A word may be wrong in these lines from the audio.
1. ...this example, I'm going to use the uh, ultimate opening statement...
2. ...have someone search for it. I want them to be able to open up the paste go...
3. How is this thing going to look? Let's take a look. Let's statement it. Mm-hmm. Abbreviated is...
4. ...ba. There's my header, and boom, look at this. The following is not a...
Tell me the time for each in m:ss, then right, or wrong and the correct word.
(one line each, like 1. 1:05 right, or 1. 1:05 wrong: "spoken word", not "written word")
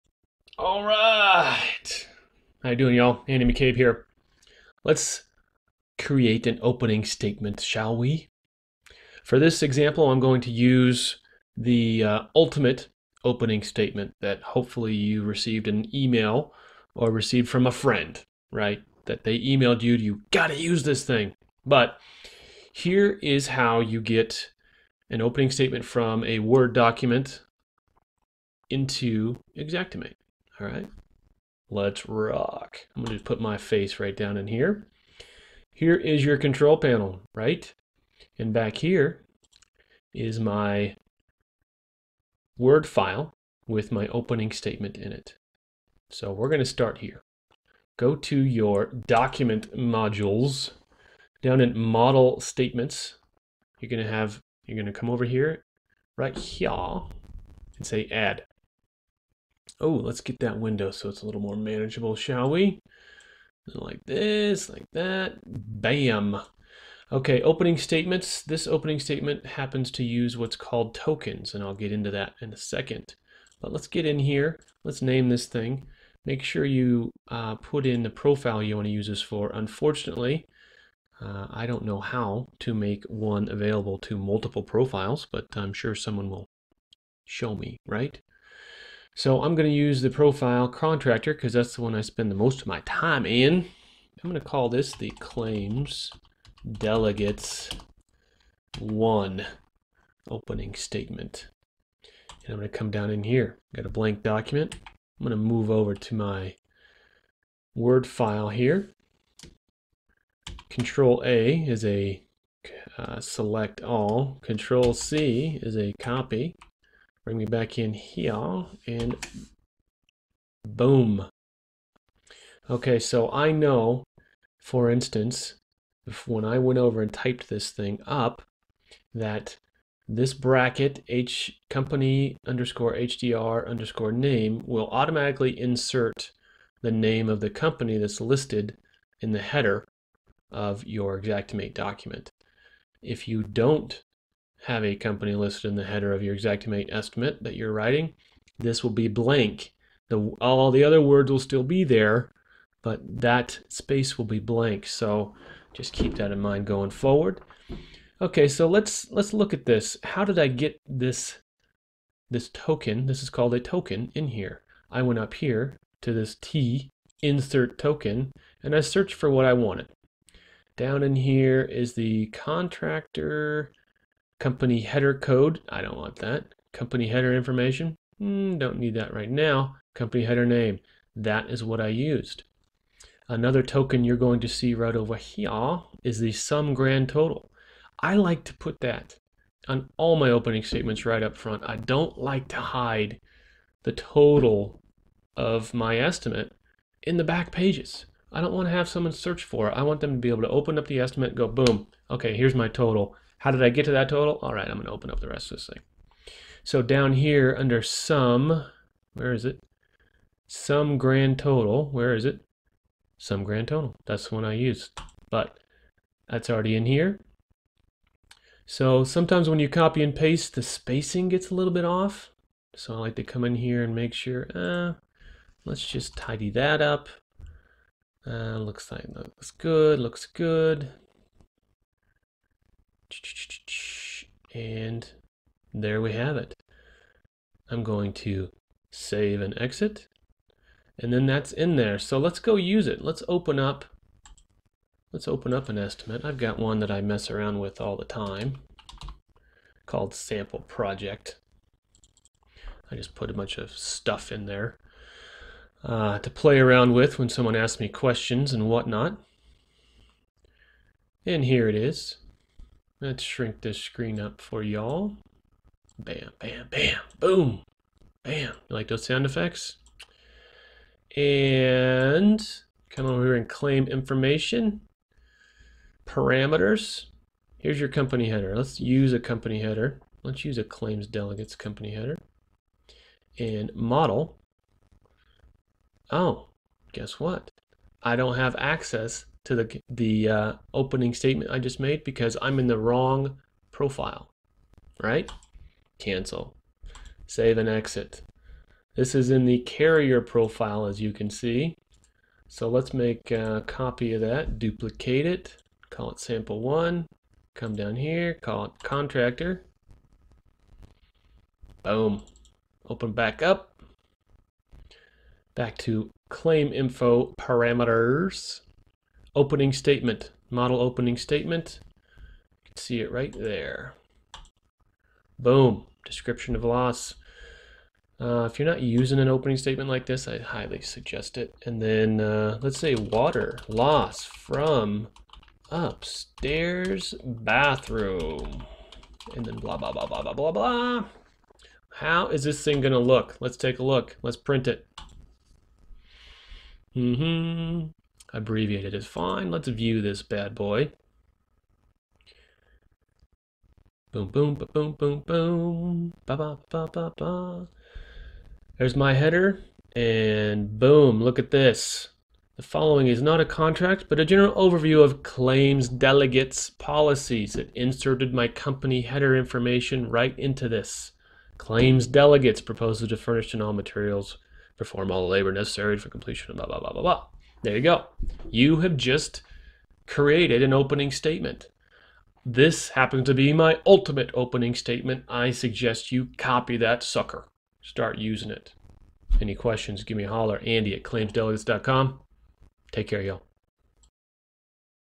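1. 0:09 right
2. 3:18 wrong: "estimate", not "paste"
3. 5:41 wrong: "print", not "statement"
4. 5:57 right.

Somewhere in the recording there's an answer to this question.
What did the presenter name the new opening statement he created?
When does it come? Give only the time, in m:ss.
1:35.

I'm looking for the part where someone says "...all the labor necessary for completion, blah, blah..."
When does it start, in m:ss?
6:15.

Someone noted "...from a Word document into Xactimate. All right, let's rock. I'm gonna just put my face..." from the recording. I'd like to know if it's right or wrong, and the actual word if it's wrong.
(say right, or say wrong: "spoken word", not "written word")
right.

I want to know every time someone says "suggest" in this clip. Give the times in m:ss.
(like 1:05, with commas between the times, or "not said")
5:30, 6:25.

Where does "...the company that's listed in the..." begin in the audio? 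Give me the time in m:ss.
2:17.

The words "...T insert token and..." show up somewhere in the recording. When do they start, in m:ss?
2:46.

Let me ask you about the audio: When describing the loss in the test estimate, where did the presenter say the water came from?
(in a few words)
Upstairs bathroom.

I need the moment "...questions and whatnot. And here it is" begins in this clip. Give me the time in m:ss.
4:17.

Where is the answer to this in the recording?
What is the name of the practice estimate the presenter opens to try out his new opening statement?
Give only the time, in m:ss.
4:10.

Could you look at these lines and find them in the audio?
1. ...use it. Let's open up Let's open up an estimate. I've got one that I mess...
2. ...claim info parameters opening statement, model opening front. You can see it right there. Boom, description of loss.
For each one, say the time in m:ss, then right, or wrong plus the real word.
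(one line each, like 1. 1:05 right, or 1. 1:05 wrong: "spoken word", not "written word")
1. 4:02 right
2. 5:16 wrong: "statement", not "front".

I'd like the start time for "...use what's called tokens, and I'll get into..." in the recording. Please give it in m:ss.
1:10.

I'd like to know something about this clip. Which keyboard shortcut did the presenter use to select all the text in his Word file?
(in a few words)
Control A.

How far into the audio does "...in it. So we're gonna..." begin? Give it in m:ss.
0:44.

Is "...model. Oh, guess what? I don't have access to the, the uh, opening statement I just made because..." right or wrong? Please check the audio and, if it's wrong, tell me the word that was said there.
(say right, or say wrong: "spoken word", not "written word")
right.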